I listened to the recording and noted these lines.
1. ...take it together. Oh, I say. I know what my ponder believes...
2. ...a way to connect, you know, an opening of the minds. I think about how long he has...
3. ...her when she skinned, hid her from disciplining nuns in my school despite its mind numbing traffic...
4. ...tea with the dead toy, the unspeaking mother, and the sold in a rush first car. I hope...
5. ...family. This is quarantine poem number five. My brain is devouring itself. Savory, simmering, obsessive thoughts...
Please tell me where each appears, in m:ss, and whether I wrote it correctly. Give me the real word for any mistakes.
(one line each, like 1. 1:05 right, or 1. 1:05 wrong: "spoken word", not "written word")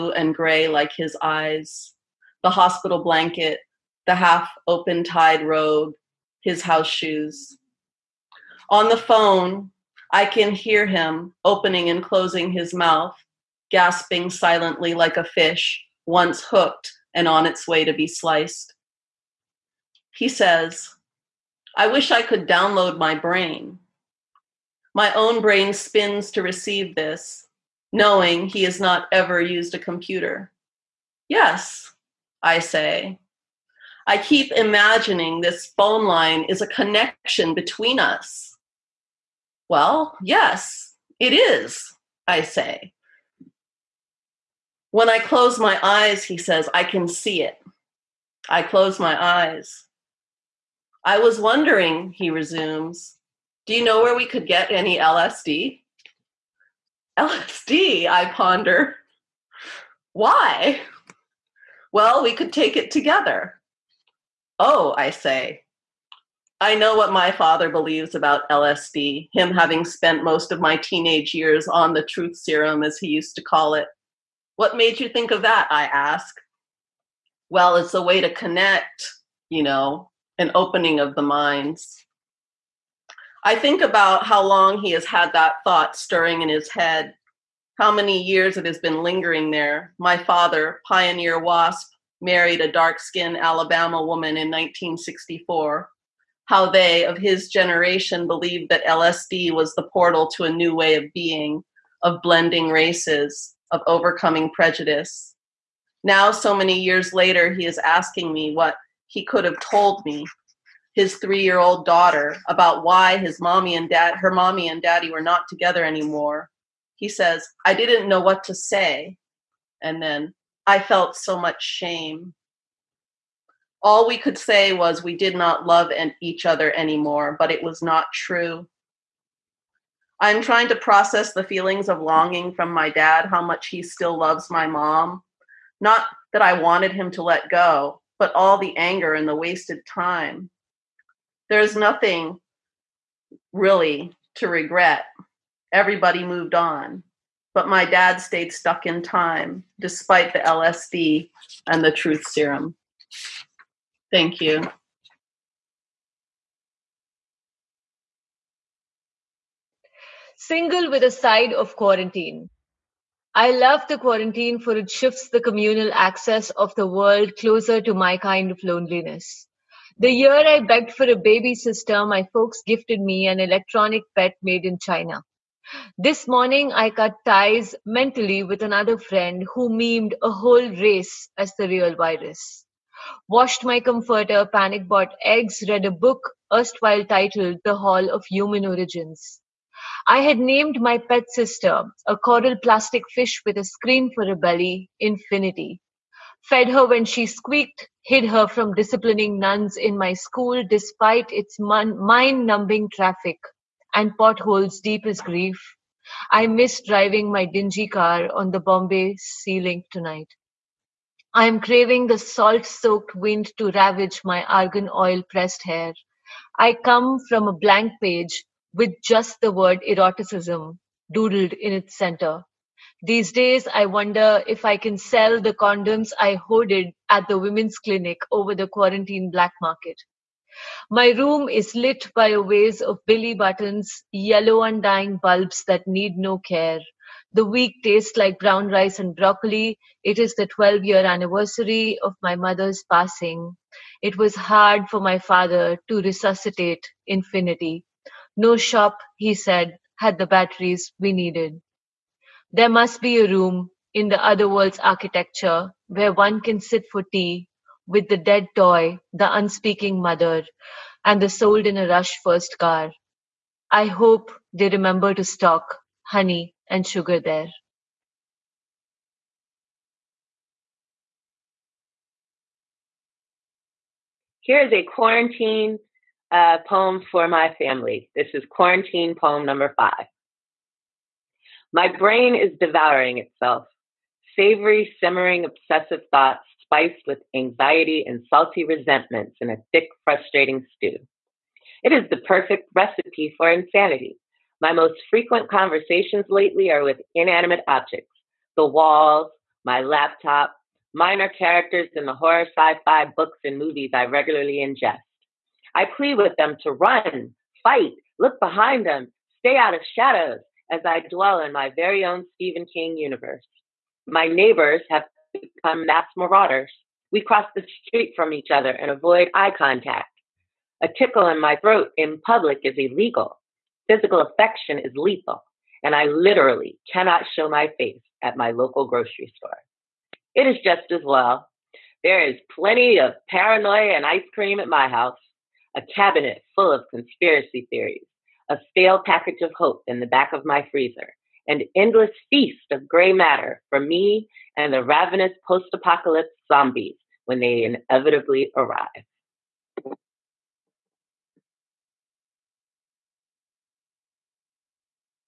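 1. 1:02 wrong: "father", not "ponder"
2. 1:17 right
3. 3:16 wrong: "squeaked", not "skinned"
4. 4:17 right
5. 4:37 right.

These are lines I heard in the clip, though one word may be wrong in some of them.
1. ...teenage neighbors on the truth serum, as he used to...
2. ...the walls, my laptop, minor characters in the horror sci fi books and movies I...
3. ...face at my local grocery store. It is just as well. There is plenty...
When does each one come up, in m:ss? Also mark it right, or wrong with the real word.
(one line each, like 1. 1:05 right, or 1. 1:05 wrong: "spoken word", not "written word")
1. 1:10 wrong: "years", not "neighbors"
2. 4:58 right
3. 5:27 right.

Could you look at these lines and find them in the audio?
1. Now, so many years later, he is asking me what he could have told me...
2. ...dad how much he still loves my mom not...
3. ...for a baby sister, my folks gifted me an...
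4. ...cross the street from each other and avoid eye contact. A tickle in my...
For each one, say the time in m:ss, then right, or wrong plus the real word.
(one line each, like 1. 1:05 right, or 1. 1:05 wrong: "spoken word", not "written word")
1. 1:46 right
2. 2:12 right
3. 2:50 right
4. 5:17 right.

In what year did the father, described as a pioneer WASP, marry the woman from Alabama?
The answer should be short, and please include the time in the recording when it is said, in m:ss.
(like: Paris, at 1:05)
1964, at 1:34.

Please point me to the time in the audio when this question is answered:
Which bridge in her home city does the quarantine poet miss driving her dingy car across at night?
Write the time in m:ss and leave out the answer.
3:28.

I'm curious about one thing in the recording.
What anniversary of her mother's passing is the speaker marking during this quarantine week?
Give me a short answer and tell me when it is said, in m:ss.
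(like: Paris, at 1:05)
12 years, at 4:00.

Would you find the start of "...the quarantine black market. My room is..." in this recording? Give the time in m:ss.
3:48.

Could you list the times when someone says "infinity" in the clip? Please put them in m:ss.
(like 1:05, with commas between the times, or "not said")
3:14, 4:07.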